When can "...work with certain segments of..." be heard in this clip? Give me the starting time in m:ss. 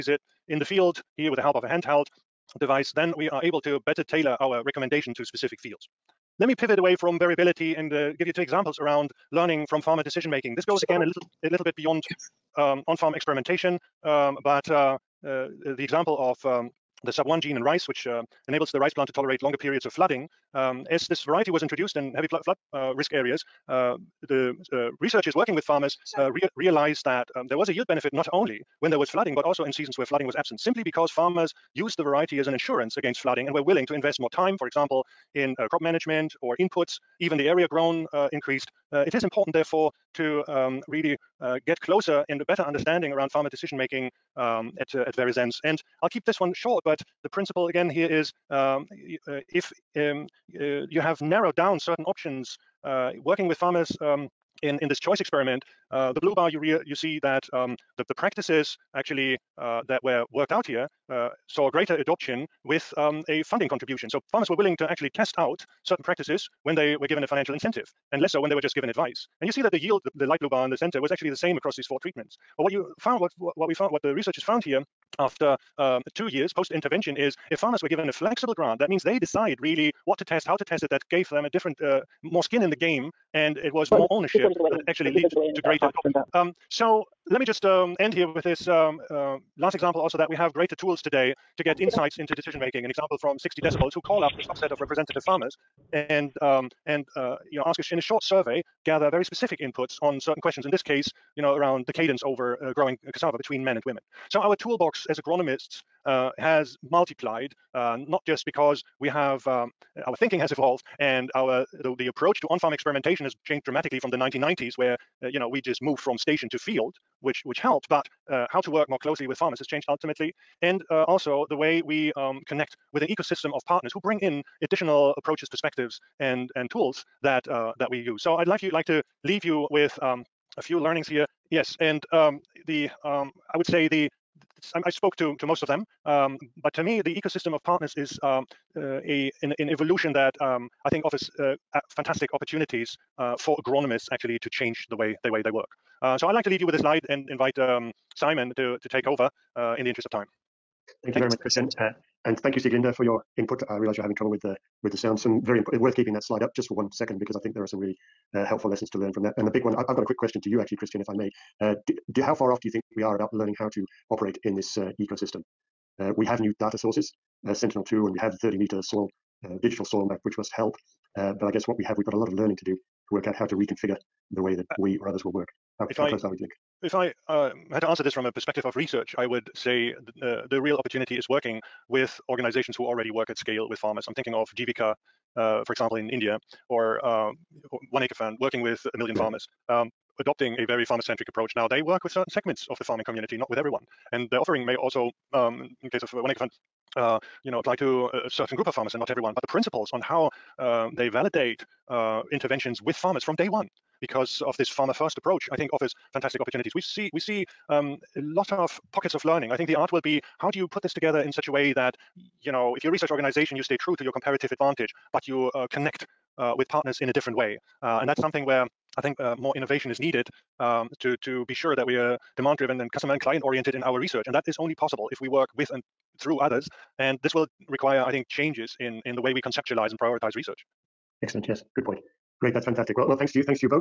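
3:11.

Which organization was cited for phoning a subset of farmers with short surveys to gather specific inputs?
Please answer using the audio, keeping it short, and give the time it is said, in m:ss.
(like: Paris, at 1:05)
60 Decibels, at 1:33.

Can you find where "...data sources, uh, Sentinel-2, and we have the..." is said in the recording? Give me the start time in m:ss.
2:46.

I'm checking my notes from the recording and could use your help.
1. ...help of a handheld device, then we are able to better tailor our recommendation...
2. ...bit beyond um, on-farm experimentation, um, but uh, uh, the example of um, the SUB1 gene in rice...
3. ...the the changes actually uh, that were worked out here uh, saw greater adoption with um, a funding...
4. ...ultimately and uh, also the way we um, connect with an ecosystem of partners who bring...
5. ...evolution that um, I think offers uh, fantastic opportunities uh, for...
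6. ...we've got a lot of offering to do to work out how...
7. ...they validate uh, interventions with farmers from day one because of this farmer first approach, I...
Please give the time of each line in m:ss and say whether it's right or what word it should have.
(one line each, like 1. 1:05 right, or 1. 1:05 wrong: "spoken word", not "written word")
1. 0:01 right
2. 0:11 right
3. 0:57 wrong: "practices", not "changes"
4. 1:59 right
5. 2:19 right
6. 2:51 wrong: "learning", not "offering"
7. 3:20 right.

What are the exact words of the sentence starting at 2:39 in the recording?
And the big one, I've, I've, got a quick question to you actually, Christian, if I may.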